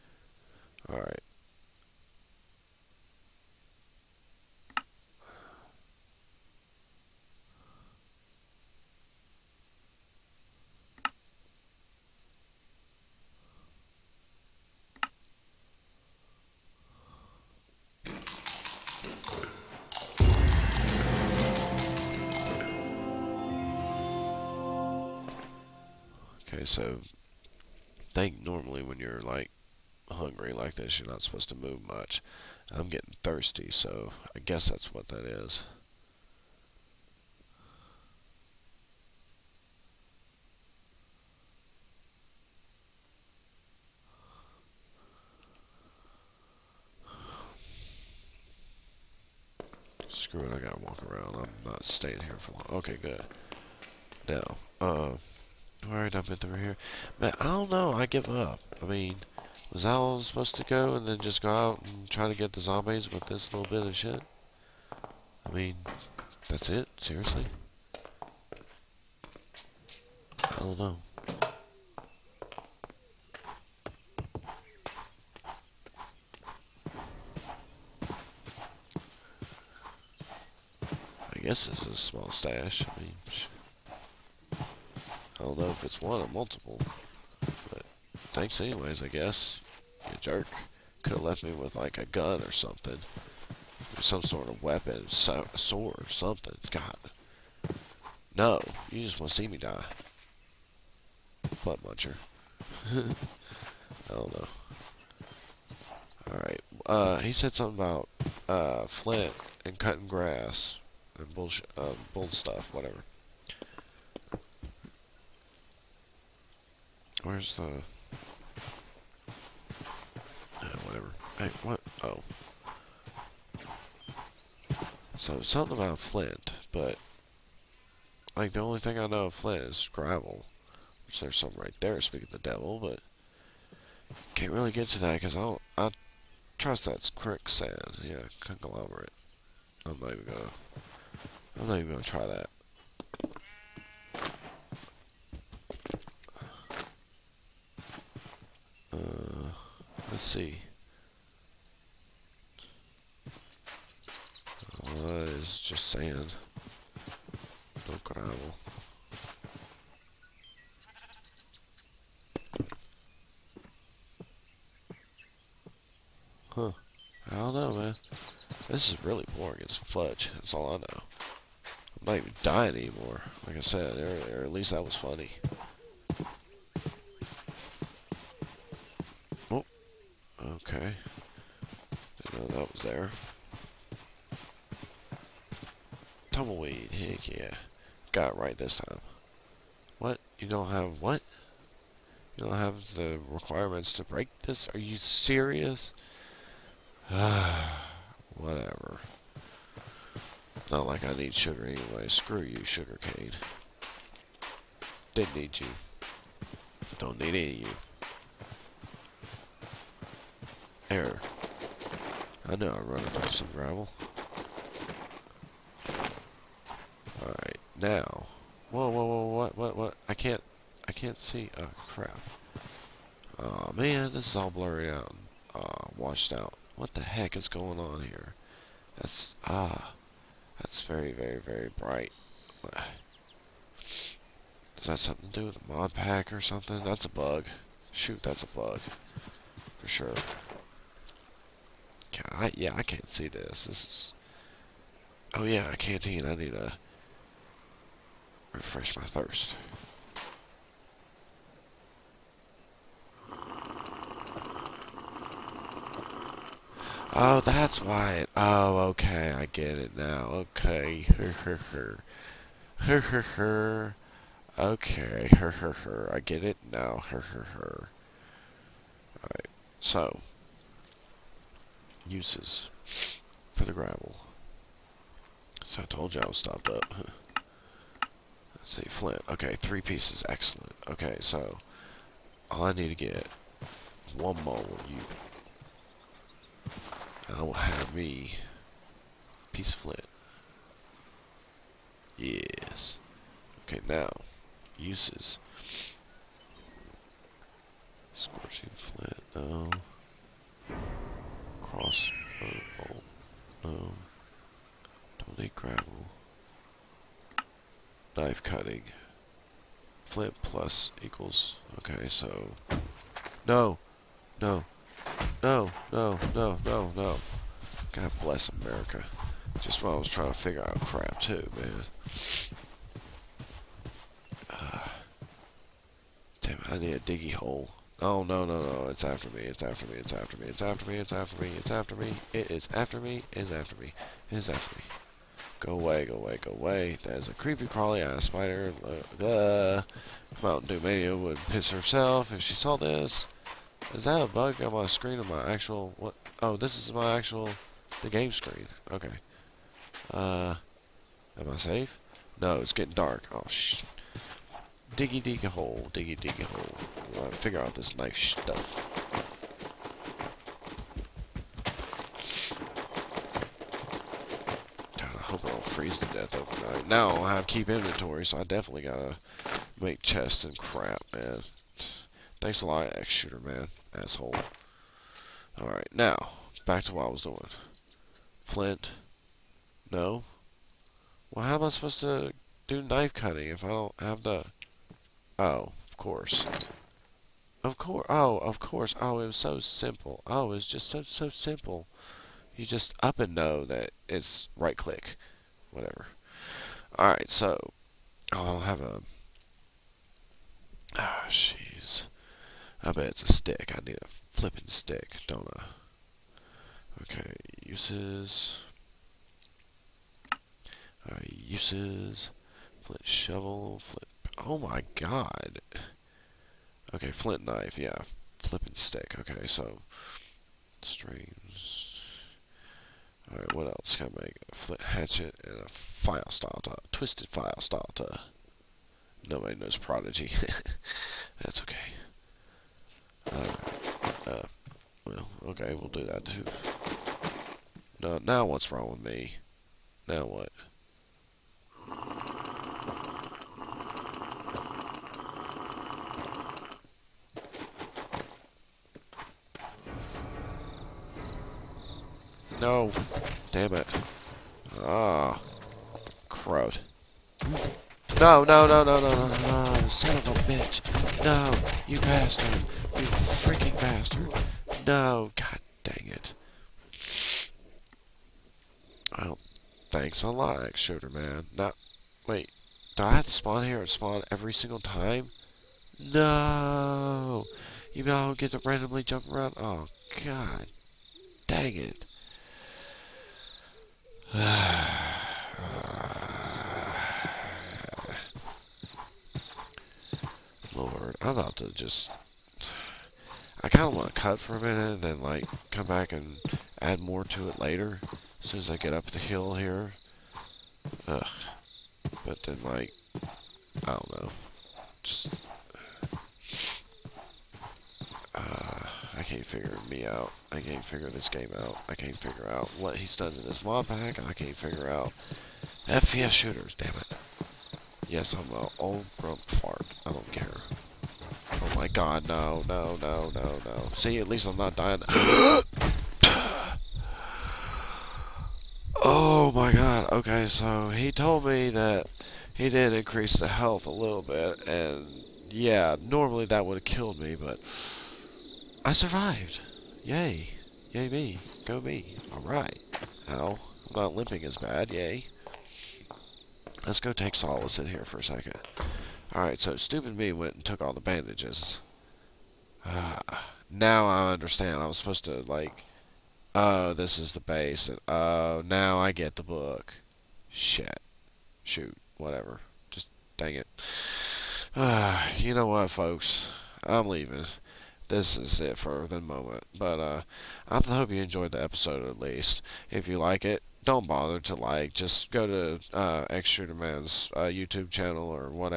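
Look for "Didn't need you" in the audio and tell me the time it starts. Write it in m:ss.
3:25.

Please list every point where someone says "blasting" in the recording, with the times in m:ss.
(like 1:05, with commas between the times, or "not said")
not said.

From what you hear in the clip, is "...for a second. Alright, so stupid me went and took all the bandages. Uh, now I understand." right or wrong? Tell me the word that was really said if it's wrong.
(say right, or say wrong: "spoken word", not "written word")
right.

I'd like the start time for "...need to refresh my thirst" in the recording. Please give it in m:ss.
4:06.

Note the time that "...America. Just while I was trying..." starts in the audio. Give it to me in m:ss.
5:18.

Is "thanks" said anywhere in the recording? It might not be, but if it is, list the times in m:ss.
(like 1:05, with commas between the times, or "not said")
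1:28, 6:12, 7:49.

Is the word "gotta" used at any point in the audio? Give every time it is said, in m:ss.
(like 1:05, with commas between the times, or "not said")
0:50, 6:08.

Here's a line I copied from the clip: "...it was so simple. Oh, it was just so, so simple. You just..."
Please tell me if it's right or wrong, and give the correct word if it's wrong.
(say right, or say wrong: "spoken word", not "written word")
right.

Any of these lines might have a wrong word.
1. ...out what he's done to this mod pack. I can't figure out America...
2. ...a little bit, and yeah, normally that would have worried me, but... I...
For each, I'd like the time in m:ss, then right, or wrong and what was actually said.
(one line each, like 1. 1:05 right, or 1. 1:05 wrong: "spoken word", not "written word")
1. 8:32 wrong: "FPS", not "America"
2. 8:53 wrong: "killed", not "worried".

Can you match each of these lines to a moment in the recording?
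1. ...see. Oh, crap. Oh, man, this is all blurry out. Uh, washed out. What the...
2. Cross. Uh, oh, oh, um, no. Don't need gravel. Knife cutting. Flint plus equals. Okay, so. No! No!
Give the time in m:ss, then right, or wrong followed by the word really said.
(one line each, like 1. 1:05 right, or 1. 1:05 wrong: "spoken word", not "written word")
1. 3:41 right
2. 5:01 right.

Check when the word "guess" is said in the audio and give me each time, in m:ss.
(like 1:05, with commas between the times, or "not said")
0:34, 1:21, 1:29.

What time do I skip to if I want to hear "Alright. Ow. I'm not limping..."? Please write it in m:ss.
9:02.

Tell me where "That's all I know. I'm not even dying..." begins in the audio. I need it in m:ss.
2:50.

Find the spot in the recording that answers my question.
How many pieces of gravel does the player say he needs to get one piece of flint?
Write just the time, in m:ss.
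4:39.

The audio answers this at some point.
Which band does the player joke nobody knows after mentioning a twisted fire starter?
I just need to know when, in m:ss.
7:09.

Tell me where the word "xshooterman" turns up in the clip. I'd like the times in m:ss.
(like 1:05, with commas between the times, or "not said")
6:12, 7:50, 9:36.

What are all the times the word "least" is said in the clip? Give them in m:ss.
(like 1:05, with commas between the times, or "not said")
2:54, 8:44, 9:32.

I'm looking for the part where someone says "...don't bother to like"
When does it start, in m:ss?
9:33.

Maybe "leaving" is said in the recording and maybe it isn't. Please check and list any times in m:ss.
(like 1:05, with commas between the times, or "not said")
9:27.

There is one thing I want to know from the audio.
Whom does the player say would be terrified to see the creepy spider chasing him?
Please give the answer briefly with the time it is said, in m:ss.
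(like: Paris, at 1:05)
Mountain Dew Mania, at 5:40.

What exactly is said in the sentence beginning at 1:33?
some sort of weapon, so sword or something.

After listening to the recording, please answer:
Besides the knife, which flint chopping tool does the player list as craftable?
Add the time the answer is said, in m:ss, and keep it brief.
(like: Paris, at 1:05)
Flint hatchet, at 7:04.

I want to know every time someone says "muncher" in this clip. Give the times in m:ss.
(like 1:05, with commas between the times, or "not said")
1:41.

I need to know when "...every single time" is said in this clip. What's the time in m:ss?
7:54.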